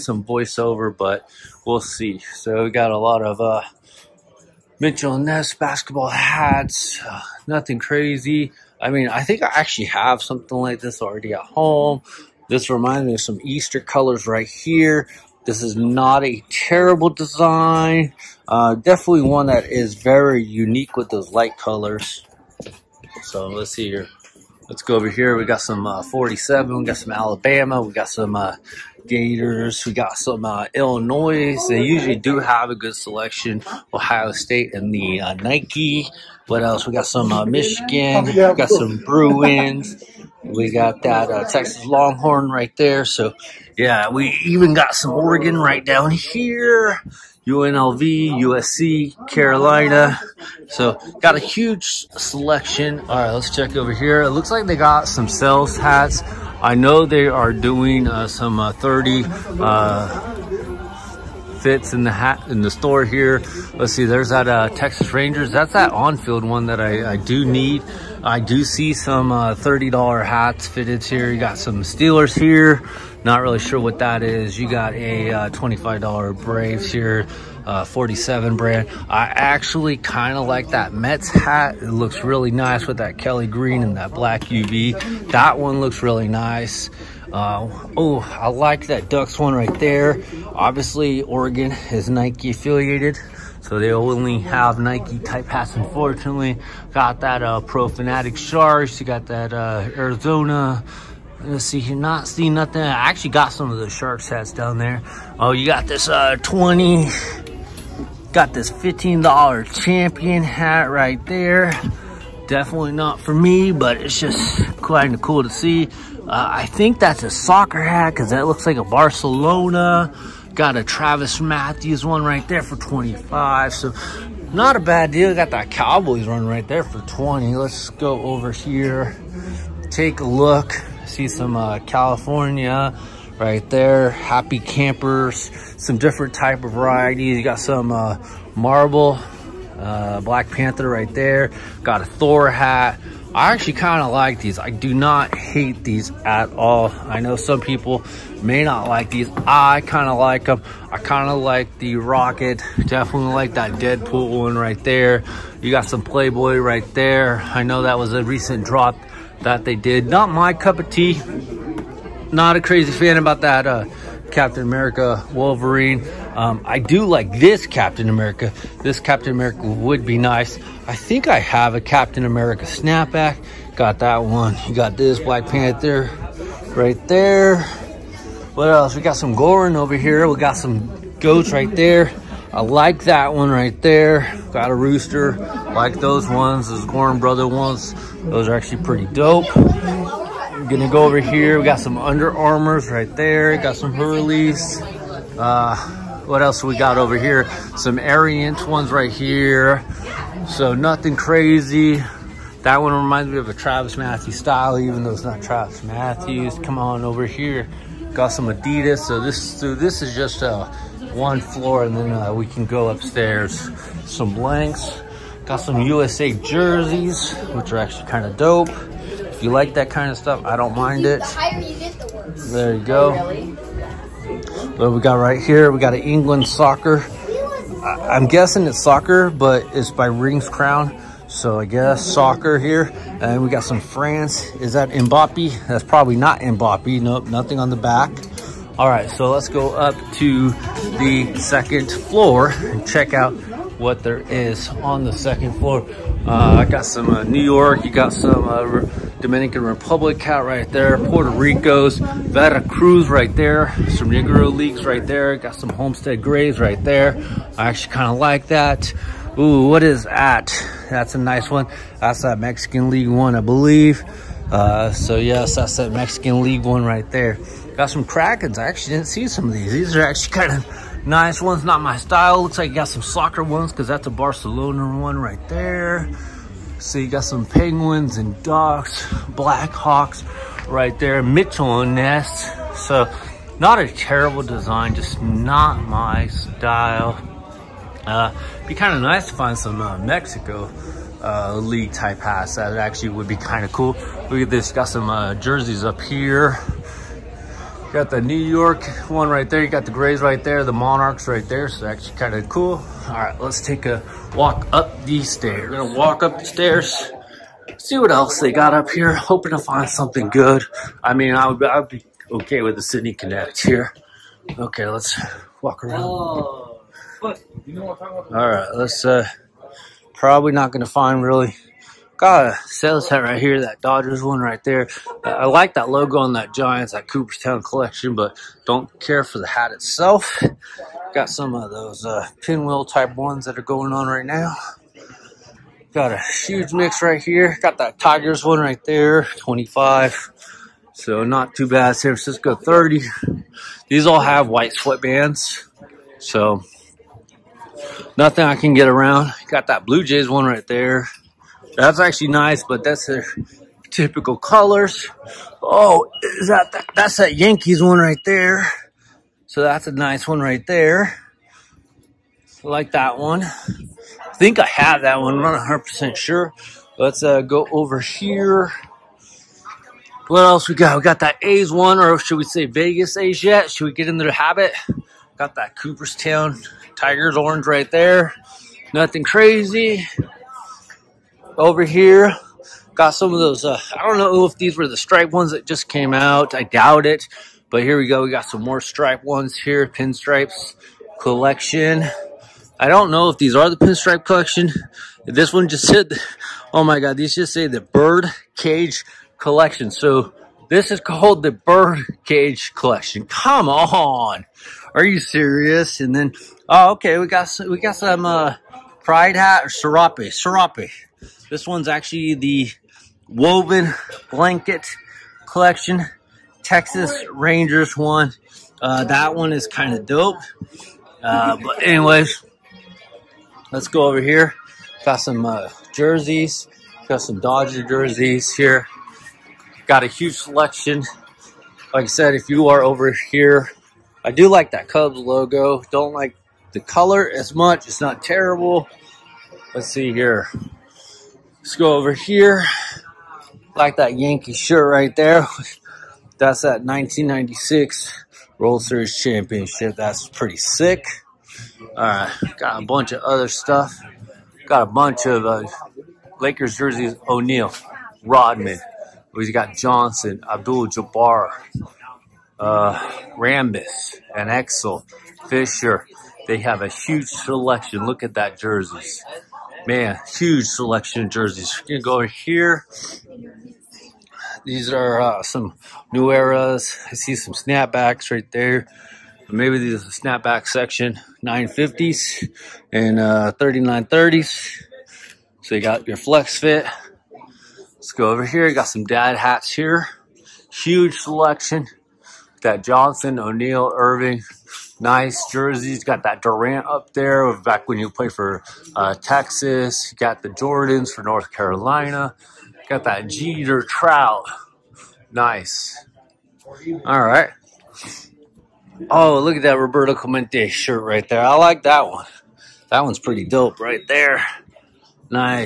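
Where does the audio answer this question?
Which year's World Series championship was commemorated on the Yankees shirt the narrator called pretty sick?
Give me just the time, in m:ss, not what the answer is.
7:26.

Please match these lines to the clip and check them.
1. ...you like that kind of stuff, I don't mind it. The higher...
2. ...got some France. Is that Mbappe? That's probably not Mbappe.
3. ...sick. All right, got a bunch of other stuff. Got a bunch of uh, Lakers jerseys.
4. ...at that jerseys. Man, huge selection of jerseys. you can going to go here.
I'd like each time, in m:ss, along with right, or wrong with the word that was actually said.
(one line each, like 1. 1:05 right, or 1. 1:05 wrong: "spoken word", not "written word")
1. 3:39 right
2. 3:53 right
3. 7:30 right
4. 7:48 right.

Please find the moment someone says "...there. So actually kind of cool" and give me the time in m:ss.
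5:01.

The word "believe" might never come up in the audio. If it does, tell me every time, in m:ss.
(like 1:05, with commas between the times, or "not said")
4:23.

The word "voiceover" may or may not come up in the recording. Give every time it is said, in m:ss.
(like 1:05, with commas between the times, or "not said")
0:00.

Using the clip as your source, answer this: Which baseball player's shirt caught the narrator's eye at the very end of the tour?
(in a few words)
Roberto Clemente.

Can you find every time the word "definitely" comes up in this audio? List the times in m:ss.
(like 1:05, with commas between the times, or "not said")
0:18, 1:52, 2:32.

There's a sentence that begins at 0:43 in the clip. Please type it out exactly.
So, yeah, we even got some Oregon right down here.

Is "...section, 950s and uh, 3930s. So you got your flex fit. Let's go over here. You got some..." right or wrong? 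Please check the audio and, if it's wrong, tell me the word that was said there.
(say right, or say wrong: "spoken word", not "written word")
right.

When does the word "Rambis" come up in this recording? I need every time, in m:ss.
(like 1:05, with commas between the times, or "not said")
7:43.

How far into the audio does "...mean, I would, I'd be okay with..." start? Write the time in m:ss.
5:11.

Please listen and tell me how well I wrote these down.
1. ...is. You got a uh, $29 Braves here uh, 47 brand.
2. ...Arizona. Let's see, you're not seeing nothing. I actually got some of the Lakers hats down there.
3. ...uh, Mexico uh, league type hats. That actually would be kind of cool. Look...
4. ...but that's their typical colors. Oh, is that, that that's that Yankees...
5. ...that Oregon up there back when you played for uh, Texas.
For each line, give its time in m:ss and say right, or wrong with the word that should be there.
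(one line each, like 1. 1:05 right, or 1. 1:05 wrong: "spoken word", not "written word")
1. 1:14 wrong: "25", not "29"
2. 1:39 wrong: "Sharks", not "Lakers"
3. 4:49 right
4. 5:52 right
5. 8:16 wrong: "Durant", not "Oregon".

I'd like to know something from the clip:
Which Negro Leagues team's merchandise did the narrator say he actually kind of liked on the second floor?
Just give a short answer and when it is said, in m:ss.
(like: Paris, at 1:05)
Homestead Grays, at 4:15.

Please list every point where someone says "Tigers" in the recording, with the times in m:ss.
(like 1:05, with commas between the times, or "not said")
5:37, 6:16.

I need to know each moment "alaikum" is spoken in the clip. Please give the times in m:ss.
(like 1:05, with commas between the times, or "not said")
not said.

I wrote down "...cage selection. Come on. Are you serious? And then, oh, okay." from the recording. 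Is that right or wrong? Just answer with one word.
wrong.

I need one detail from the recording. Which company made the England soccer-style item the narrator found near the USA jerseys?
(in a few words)
Rings Crown.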